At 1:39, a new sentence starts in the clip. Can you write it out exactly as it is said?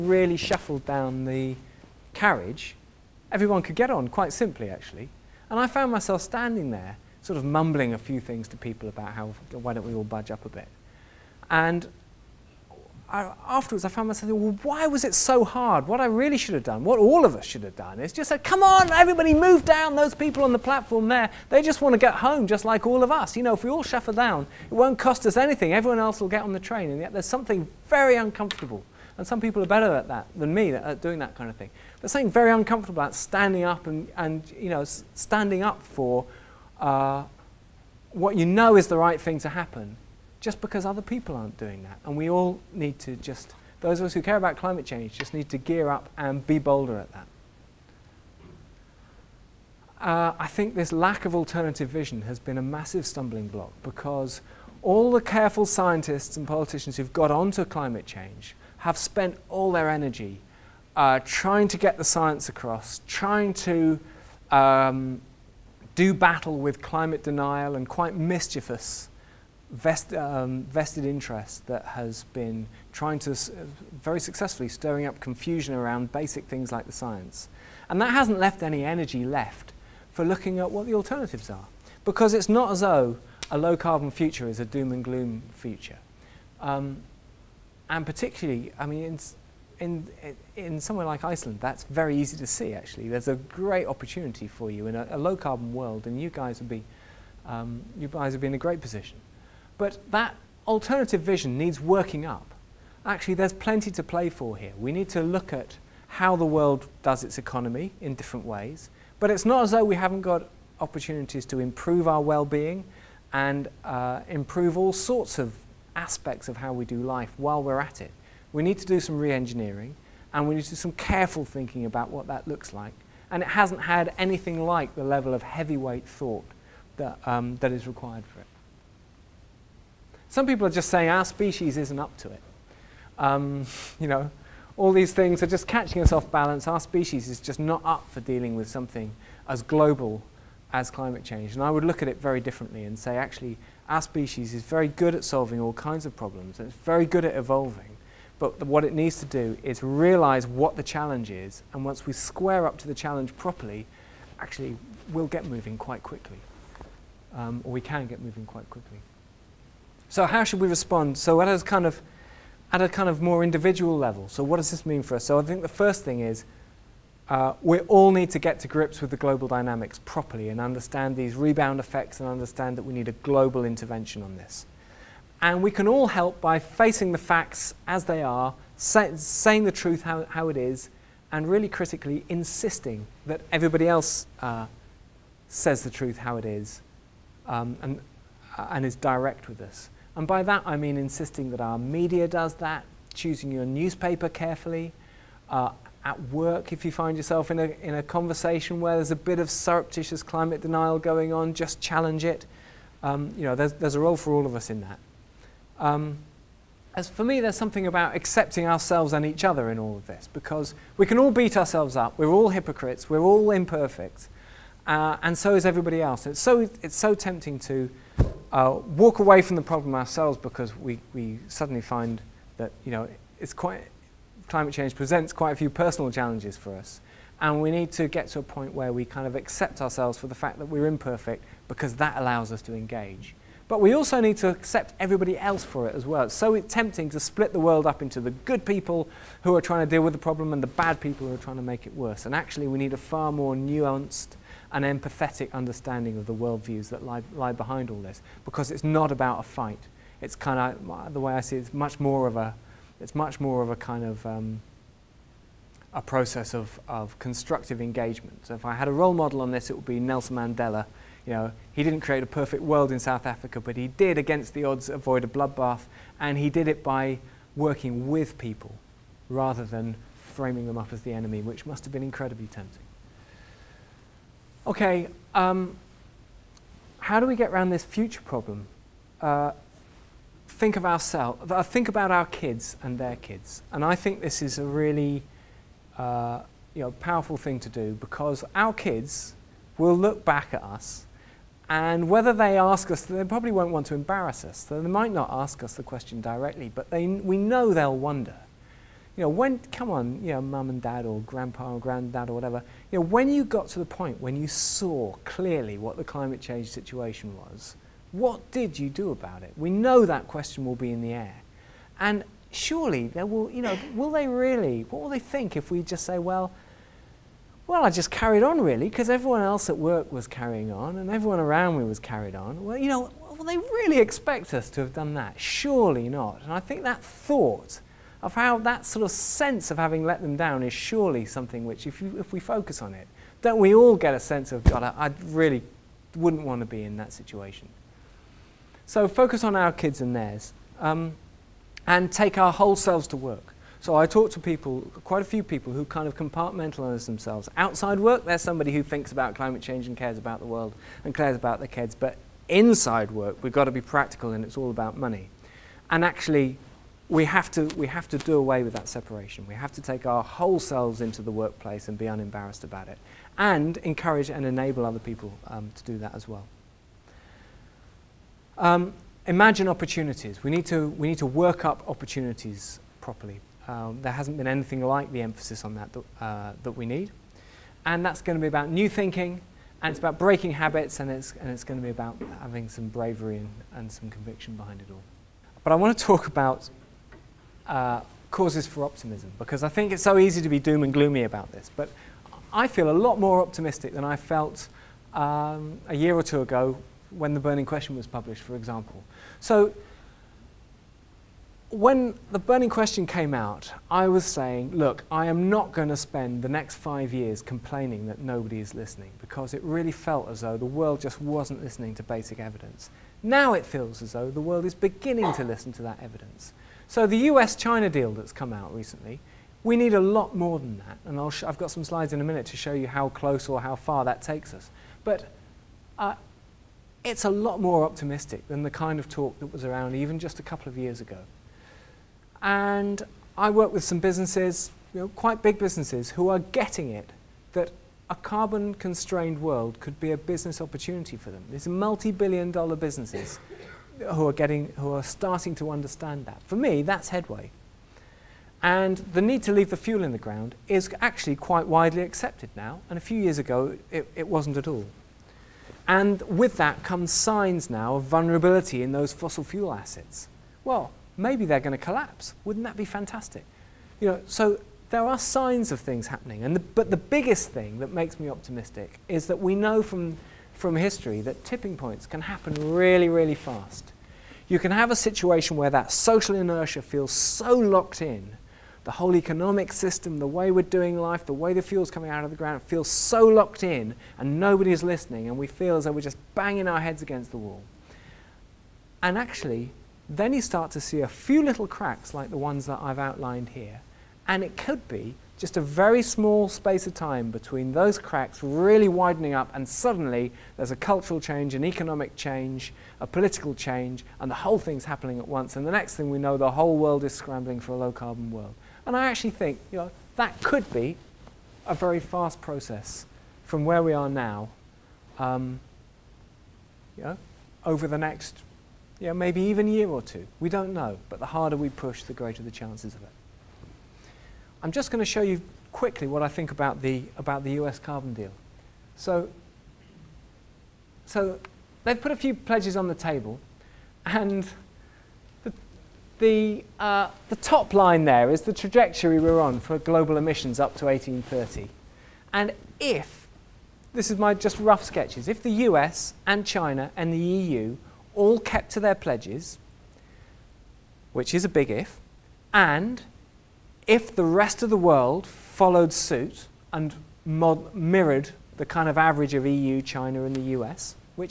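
But that alternative vision needs working up.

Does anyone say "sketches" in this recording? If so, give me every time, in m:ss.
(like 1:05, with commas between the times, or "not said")
9:04.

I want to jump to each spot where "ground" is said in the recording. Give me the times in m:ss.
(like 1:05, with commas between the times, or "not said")
7:30, 8:02.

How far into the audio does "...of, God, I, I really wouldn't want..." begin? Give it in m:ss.
5:34.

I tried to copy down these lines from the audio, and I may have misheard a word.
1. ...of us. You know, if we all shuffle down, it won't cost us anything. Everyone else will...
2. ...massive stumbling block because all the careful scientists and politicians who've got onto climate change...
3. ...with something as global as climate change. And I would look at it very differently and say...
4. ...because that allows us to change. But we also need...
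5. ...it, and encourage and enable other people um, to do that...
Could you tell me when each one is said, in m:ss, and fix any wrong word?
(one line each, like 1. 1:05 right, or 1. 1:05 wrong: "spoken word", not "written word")
1. 0:23 right
2. 0:52 right
3. 2:18 right
4. 3:51 wrong: "engage", not "change"
5. 6:02 right.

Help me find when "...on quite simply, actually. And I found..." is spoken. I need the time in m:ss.
0:03.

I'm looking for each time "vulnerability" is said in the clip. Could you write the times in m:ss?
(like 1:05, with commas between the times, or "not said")
7:38.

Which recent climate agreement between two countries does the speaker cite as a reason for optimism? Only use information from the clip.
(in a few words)
US-China deal.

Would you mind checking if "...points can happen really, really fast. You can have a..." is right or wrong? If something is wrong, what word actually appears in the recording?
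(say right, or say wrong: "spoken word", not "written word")
right.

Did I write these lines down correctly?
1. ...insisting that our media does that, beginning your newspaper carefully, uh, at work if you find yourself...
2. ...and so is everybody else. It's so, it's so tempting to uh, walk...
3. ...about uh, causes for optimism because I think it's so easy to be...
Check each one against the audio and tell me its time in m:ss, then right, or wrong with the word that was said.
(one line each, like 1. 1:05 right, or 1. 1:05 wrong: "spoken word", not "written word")
1. 3:10 wrong: "choosing", not "beginning"
2. 3:35 right
3. 6:26 right.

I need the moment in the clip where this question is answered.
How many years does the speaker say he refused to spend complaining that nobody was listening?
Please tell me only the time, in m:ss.
6:46.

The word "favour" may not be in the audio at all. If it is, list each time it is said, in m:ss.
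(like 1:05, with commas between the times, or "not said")
not said.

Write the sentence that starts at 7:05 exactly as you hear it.
But uh, it's a lot more optimistic than the kind of talk that was around even just a couple of years ago.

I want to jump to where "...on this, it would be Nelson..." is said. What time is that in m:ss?
4:19.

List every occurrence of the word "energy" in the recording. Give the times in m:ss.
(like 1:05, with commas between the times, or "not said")
0:59, 1:18.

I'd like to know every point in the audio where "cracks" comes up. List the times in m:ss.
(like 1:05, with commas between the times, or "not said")
8:11, 8:17.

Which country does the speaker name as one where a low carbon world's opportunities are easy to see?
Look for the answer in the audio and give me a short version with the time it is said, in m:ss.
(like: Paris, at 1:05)
Iceland, at 1:31.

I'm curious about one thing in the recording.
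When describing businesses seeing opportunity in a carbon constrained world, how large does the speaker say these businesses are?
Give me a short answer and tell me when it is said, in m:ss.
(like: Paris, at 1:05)
Multi billion dollar, at 7:21.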